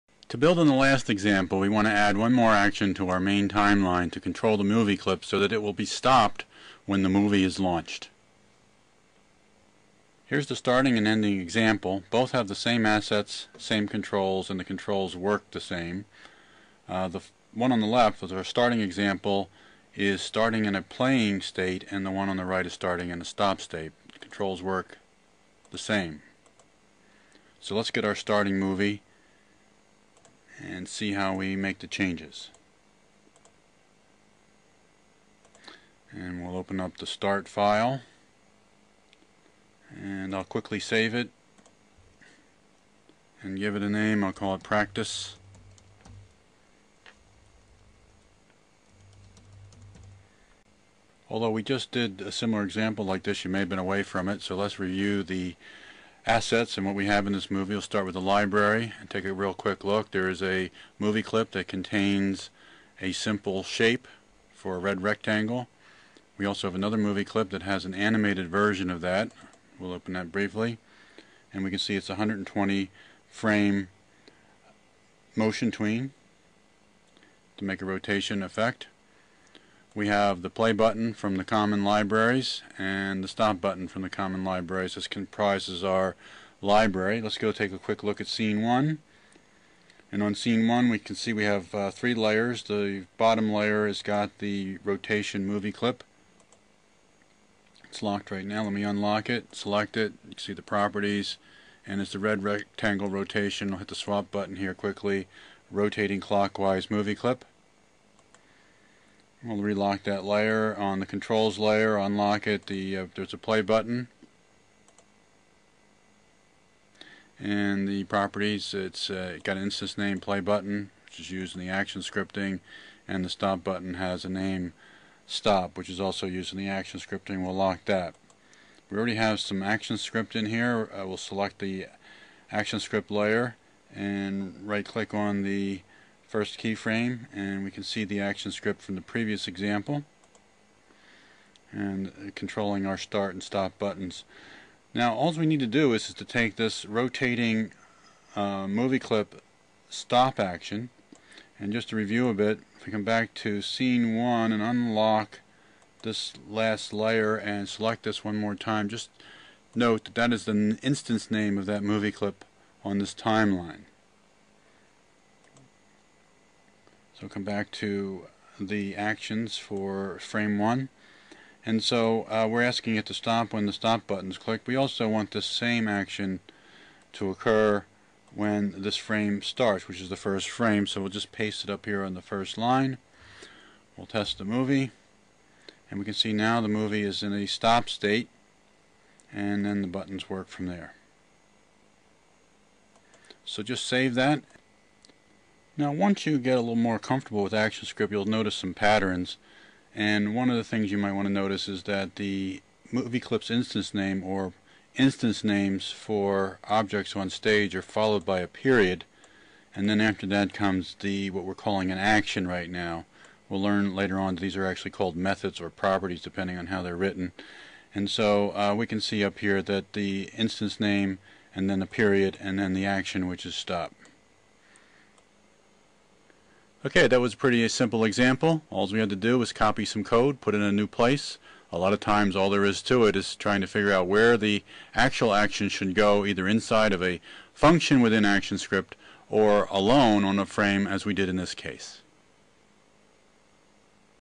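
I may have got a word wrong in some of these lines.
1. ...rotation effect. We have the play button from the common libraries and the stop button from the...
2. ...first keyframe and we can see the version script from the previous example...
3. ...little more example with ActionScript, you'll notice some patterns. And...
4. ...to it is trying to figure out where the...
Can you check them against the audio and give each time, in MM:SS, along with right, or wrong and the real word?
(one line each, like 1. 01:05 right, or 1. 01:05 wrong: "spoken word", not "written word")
1. 01:17 right
2. 02:16 wrong: "action", not "version"
3. 03:16 wrong: "comfortable", not "example"
4. 03:52 right.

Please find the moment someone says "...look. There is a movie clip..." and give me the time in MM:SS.
00:59.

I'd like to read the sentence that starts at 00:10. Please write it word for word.
Here's the starting and ending example.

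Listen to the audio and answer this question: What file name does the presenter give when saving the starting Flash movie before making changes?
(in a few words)
practice.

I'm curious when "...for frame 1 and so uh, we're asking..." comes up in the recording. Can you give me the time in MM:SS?
02:49.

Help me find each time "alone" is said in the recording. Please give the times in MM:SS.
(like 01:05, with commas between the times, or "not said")
03:59.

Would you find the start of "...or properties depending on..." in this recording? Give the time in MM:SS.
03:35.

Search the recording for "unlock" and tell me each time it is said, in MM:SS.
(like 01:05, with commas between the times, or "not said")
01:38, 01:51, 02:34.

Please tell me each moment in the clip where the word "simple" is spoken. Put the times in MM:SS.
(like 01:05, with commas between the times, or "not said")
01:03, 03:47.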